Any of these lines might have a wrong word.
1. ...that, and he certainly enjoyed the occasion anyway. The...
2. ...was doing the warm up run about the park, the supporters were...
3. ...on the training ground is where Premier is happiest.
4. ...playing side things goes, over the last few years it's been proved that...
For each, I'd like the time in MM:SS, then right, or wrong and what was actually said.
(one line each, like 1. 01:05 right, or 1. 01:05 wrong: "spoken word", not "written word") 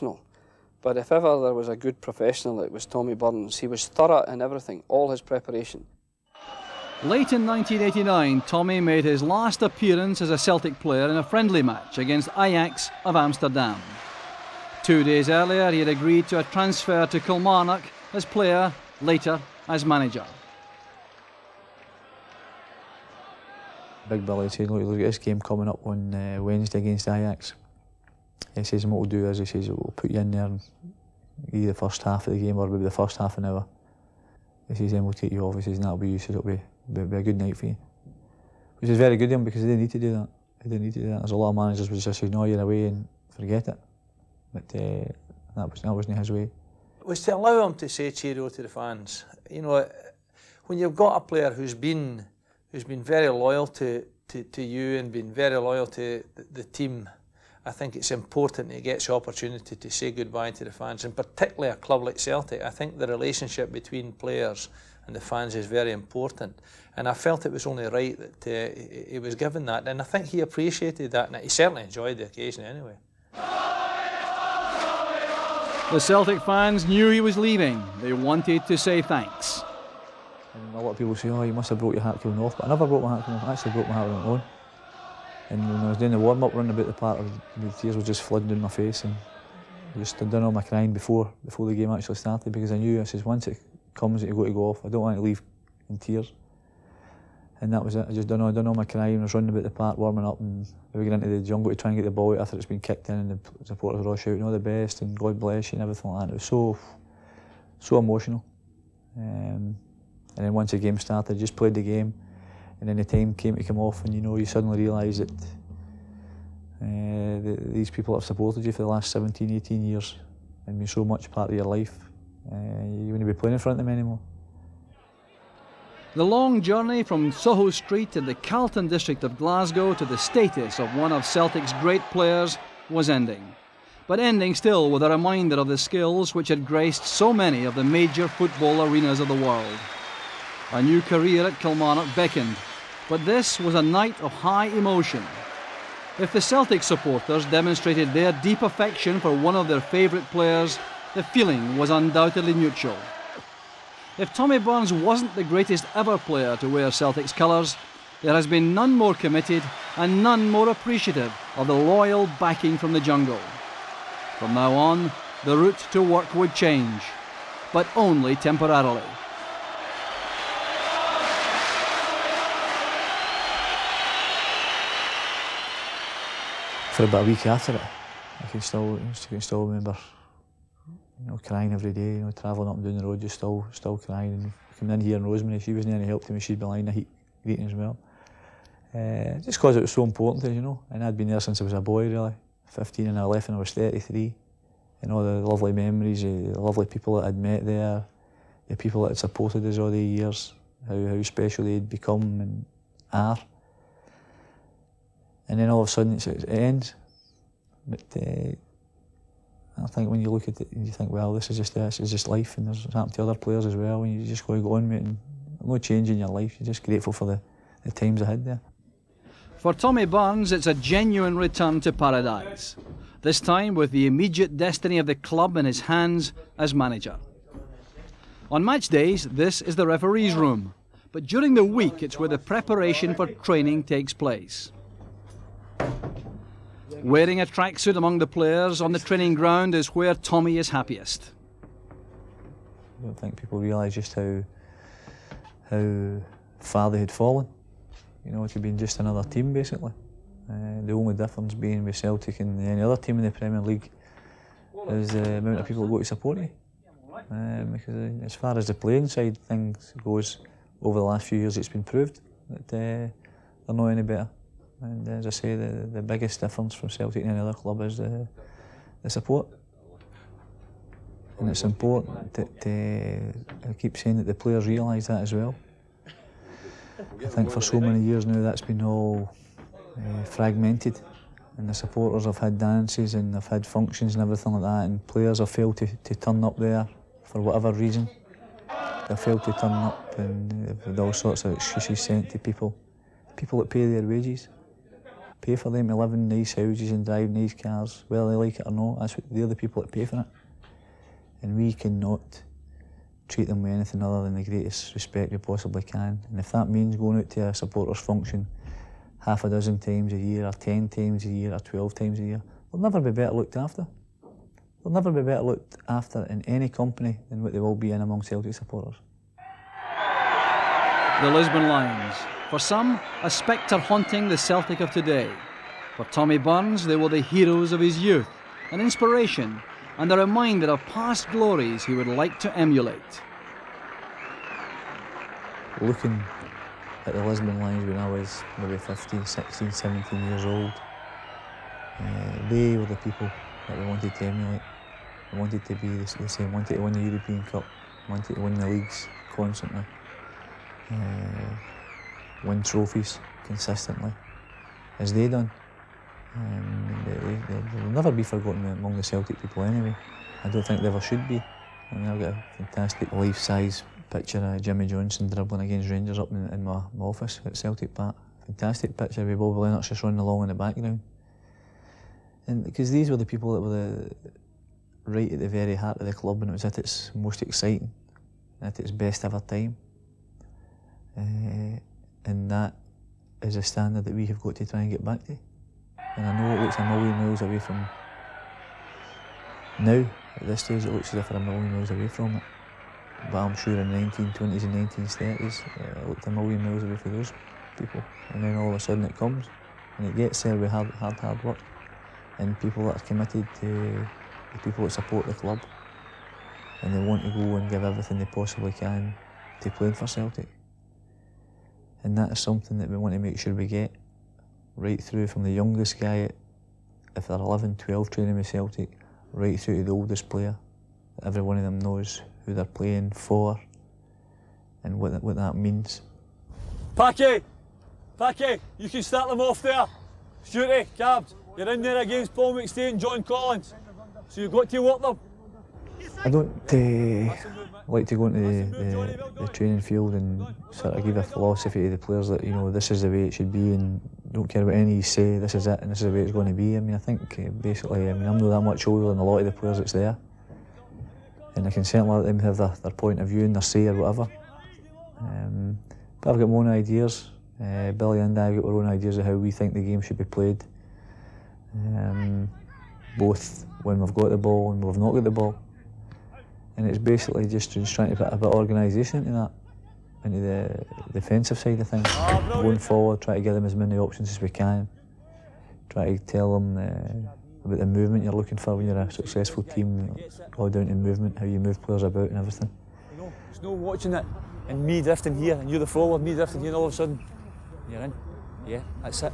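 1. 01:11 right
2. 01:25 wrong: "tears", not "supporters"
3. 03:58 wrong: "Tommy", not "Premier"
4. 04:18 right.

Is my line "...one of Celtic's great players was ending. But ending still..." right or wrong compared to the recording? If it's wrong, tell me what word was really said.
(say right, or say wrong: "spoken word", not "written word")
right.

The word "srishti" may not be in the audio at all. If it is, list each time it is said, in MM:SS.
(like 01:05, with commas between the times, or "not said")
not said.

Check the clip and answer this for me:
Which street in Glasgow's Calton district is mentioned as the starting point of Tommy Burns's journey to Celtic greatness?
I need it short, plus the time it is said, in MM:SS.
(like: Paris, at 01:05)
Soho Street, at 02:07.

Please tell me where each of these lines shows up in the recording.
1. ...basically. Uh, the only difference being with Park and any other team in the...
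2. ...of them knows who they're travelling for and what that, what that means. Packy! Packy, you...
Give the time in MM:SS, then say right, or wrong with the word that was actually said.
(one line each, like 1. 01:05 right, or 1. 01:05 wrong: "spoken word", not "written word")
1. 04:09 wrong: "Celtic", not "Park"
2. 07:01 wrong: "playing", not "travelling".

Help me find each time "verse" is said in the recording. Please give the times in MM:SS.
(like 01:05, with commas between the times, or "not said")
not said.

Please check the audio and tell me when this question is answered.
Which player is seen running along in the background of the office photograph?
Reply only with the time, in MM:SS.
06:09.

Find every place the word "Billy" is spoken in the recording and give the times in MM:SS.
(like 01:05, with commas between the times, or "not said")
00:24, 07:37.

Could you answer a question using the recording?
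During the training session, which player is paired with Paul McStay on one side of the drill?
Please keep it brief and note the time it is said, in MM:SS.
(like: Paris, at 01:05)
John Collins, at 07:12.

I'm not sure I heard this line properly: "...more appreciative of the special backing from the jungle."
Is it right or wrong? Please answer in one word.
wrong.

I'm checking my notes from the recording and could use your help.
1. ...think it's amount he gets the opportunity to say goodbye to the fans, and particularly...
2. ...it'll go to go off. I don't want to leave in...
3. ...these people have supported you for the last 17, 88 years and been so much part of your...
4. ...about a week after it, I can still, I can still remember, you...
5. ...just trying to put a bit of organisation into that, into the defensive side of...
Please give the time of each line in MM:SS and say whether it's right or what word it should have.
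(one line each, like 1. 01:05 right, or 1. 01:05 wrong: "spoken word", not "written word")
1. 00:57 wrong: "important", not "amount"
2. 01:34 right
3. 01:57 wrong: "18", not "88"
4. 02:57 right
5. 07:47 right.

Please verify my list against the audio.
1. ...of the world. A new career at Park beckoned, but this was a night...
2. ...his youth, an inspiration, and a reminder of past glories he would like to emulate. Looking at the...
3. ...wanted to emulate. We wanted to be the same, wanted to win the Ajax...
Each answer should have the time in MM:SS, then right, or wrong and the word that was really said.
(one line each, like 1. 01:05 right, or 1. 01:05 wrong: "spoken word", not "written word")
1. 02:19 wrong: "Kilmarnock", not "Park"
2. 05:27 right
3. 05:43 wrong: "European", not "Ajax".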